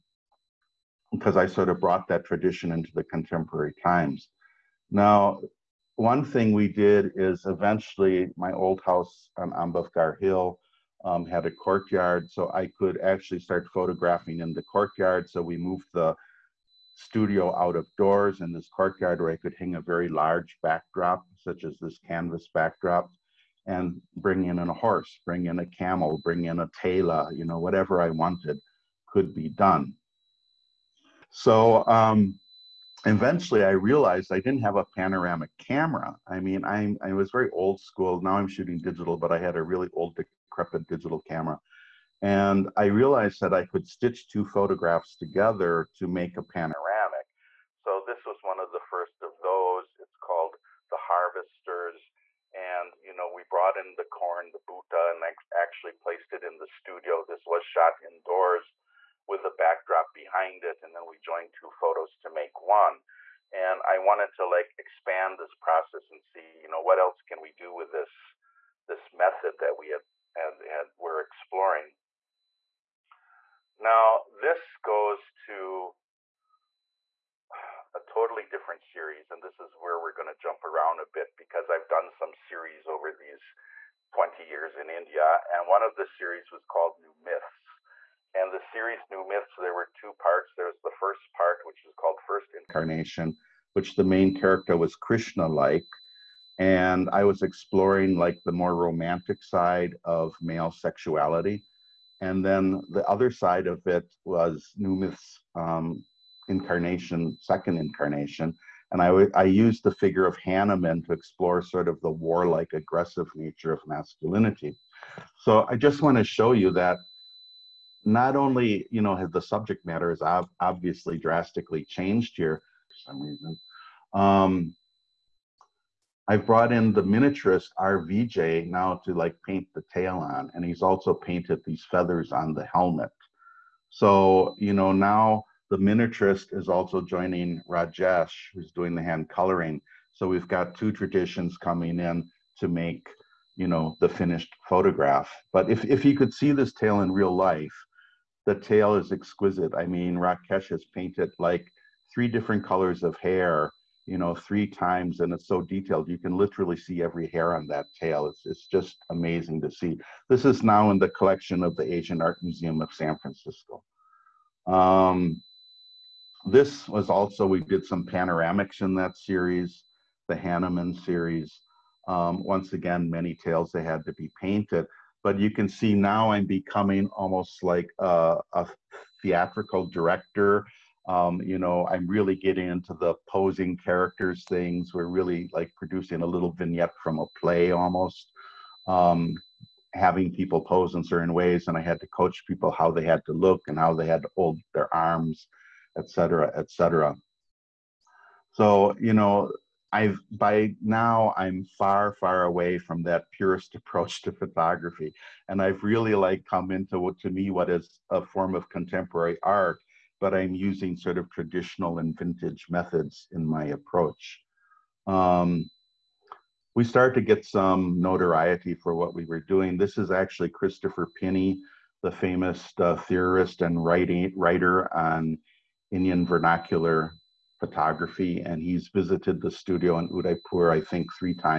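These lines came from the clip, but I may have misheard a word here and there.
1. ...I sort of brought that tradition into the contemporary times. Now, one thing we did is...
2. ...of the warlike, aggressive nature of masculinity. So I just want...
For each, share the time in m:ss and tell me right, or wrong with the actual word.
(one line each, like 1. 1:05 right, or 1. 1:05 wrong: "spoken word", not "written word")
1. 0:01 right
2. 1:51 right.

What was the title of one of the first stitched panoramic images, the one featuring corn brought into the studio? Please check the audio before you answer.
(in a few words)
The Harvesters.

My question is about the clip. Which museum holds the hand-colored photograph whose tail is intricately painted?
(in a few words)
Asian Art Museum of San Francisco.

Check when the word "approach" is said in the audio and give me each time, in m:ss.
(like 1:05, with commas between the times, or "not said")
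3:23, 3:33.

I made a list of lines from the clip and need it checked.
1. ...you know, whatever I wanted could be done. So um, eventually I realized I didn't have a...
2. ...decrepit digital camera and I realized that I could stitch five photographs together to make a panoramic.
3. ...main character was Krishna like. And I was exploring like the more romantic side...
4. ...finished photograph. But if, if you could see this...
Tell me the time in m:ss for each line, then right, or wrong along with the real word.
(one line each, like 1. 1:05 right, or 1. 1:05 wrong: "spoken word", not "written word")
1. 0:27 right
2. 0:40 wrong: "two", not "five"
3. 1:34 right
4. 2:24 right.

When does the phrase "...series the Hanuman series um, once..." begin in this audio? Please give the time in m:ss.
2:49.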